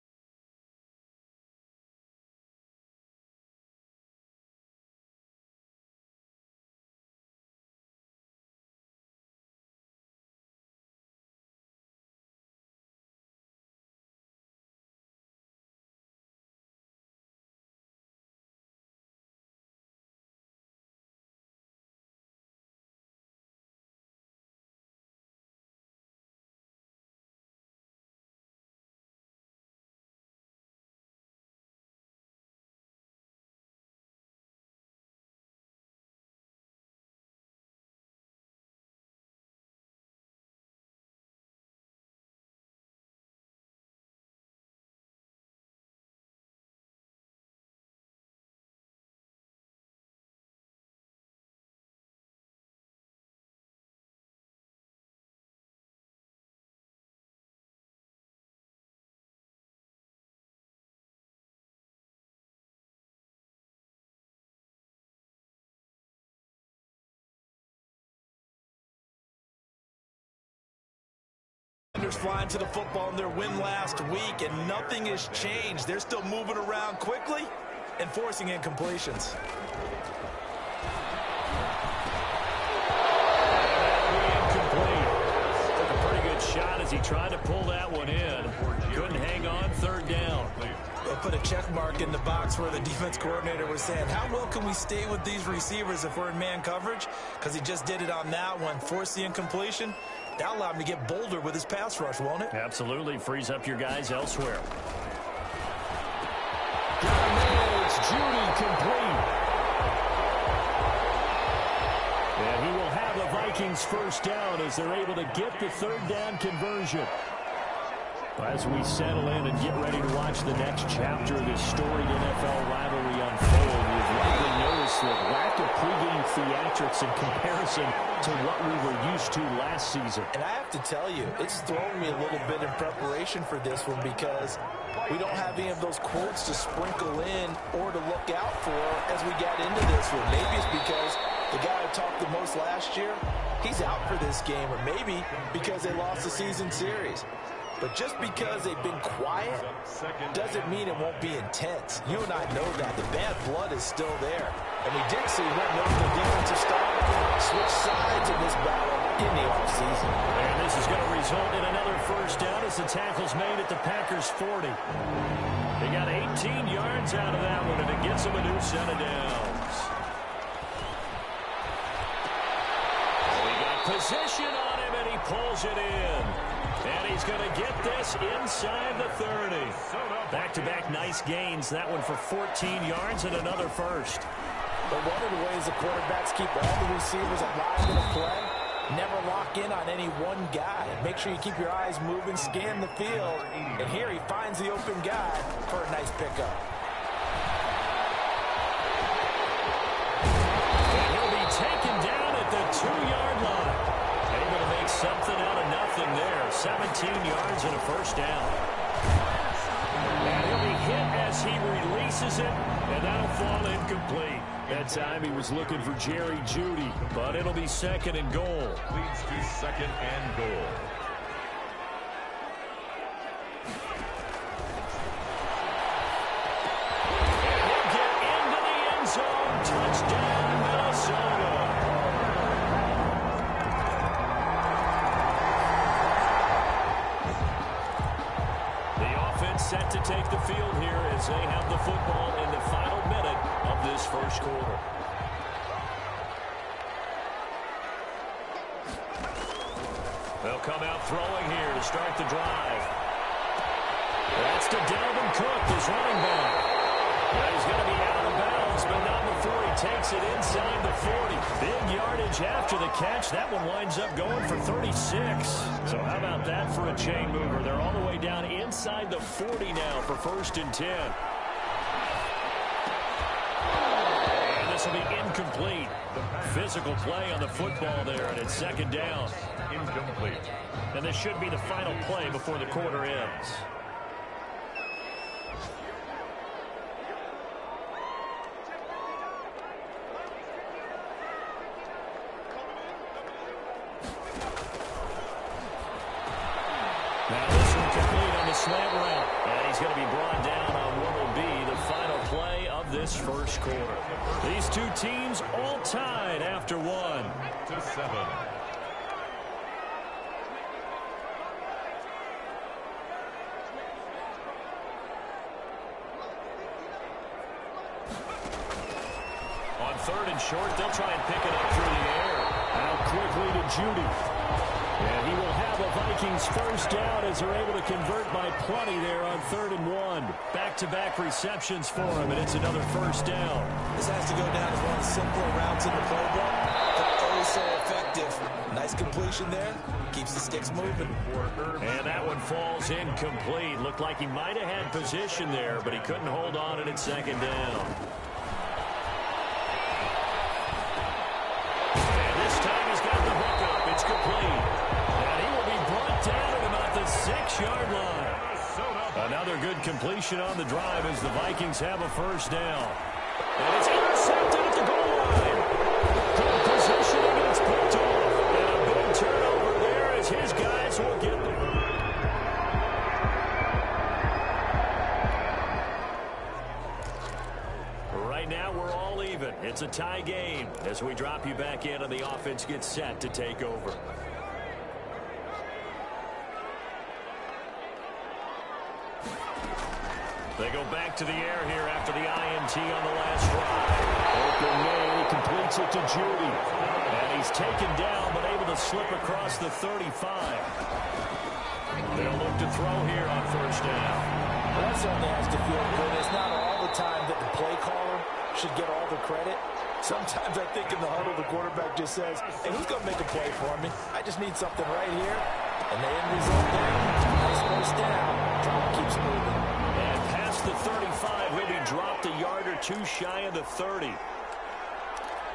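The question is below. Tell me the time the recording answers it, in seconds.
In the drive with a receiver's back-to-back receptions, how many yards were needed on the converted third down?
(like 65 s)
329 s.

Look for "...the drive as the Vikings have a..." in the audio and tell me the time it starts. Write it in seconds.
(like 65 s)
360 s.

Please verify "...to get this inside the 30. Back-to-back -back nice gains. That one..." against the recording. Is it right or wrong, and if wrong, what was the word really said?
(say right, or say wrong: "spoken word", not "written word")
right.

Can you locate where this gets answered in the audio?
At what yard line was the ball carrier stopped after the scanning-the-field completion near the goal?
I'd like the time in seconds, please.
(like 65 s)
202 s.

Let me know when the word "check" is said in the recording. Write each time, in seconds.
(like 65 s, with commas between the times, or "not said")
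91 s.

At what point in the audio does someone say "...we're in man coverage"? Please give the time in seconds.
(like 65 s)
96 s.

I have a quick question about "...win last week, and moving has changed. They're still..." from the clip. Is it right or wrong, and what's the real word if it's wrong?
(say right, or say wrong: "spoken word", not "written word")
wrong: "nothing", not "moving".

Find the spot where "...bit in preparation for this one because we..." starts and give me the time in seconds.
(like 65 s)
132 s.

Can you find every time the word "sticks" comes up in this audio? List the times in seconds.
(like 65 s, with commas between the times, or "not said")
340 s.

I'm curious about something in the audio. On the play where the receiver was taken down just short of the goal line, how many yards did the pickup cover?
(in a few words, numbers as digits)
17 yards.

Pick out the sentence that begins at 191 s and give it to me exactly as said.
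Make sure you keep your eyes moving, scan the field.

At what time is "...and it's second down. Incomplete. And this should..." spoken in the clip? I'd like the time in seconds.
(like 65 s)
278 s.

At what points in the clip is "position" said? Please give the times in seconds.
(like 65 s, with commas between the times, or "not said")
173 s, 344 s.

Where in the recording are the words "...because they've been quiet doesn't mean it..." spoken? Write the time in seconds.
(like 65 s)
148 s.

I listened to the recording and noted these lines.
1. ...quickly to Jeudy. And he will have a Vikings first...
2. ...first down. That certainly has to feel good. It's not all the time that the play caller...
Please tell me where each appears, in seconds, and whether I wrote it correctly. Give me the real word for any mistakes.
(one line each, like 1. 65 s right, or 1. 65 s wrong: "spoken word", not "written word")
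1. 323 s right
2. 403 s right.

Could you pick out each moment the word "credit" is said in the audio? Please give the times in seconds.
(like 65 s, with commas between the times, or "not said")
409 s.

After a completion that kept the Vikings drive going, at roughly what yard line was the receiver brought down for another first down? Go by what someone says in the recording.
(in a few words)
6-yard line.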